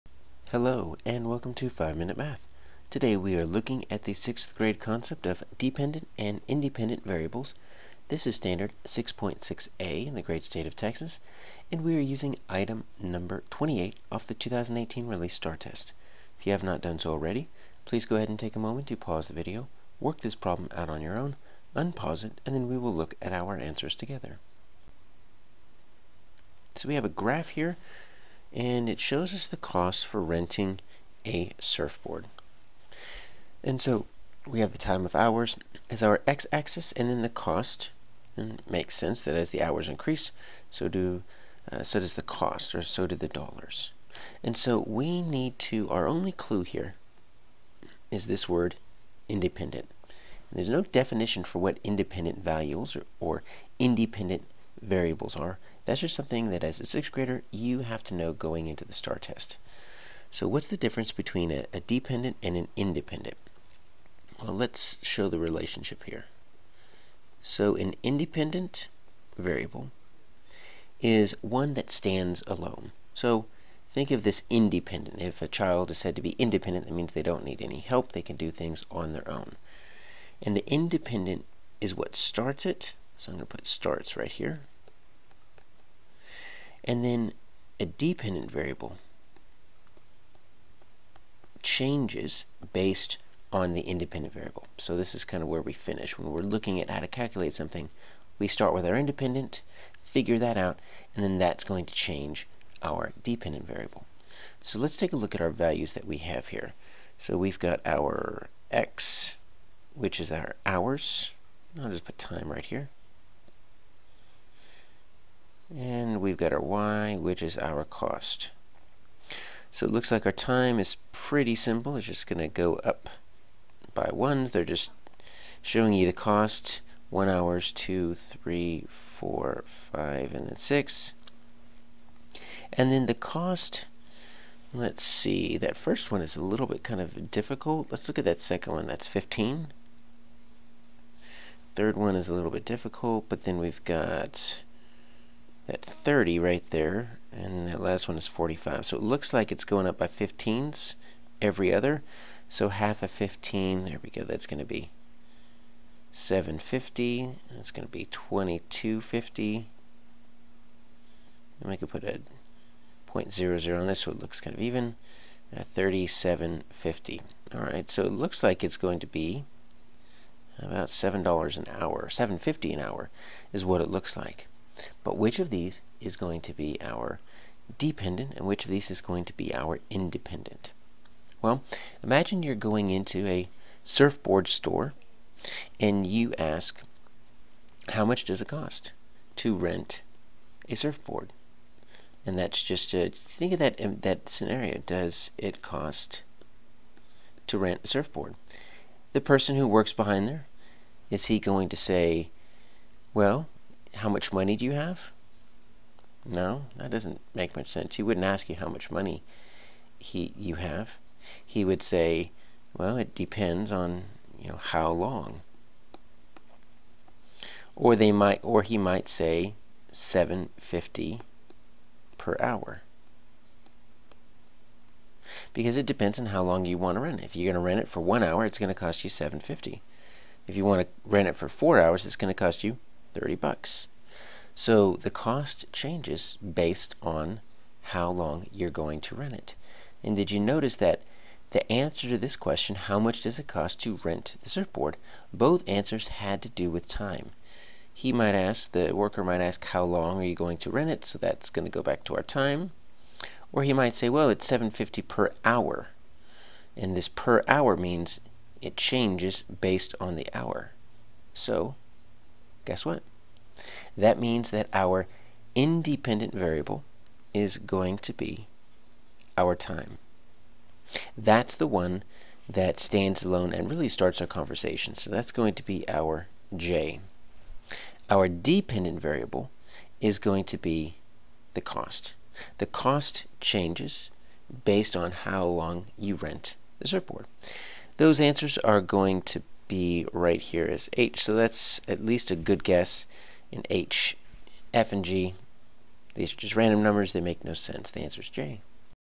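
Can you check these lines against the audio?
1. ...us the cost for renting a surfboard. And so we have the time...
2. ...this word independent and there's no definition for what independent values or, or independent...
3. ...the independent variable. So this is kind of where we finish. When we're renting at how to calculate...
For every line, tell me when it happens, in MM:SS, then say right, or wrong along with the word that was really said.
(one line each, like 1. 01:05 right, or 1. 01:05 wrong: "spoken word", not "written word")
1. 00:29 right
2. 00:48 right
3. 01:33 wrong: "looking", not "renting".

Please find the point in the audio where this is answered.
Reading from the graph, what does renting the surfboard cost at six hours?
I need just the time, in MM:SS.
02:27.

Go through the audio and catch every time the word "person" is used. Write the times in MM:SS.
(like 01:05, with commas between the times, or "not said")
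03:19.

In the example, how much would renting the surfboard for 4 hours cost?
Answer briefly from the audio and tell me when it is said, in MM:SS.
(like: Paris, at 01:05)
$30, at 03:53.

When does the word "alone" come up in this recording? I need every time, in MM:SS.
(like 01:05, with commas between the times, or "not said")
01:12, 04:33.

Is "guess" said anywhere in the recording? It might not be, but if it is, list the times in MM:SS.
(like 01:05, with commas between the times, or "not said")
04:22, 04:52.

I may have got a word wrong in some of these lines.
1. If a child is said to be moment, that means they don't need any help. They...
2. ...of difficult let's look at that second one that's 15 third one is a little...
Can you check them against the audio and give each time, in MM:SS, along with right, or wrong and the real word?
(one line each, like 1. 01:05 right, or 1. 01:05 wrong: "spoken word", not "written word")
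1. 01:15 wrong: "independent", not "moment"
2. 02:17 right.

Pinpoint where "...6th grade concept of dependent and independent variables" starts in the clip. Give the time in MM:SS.
00:04.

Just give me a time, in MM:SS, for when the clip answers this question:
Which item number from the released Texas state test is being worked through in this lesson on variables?
00:12.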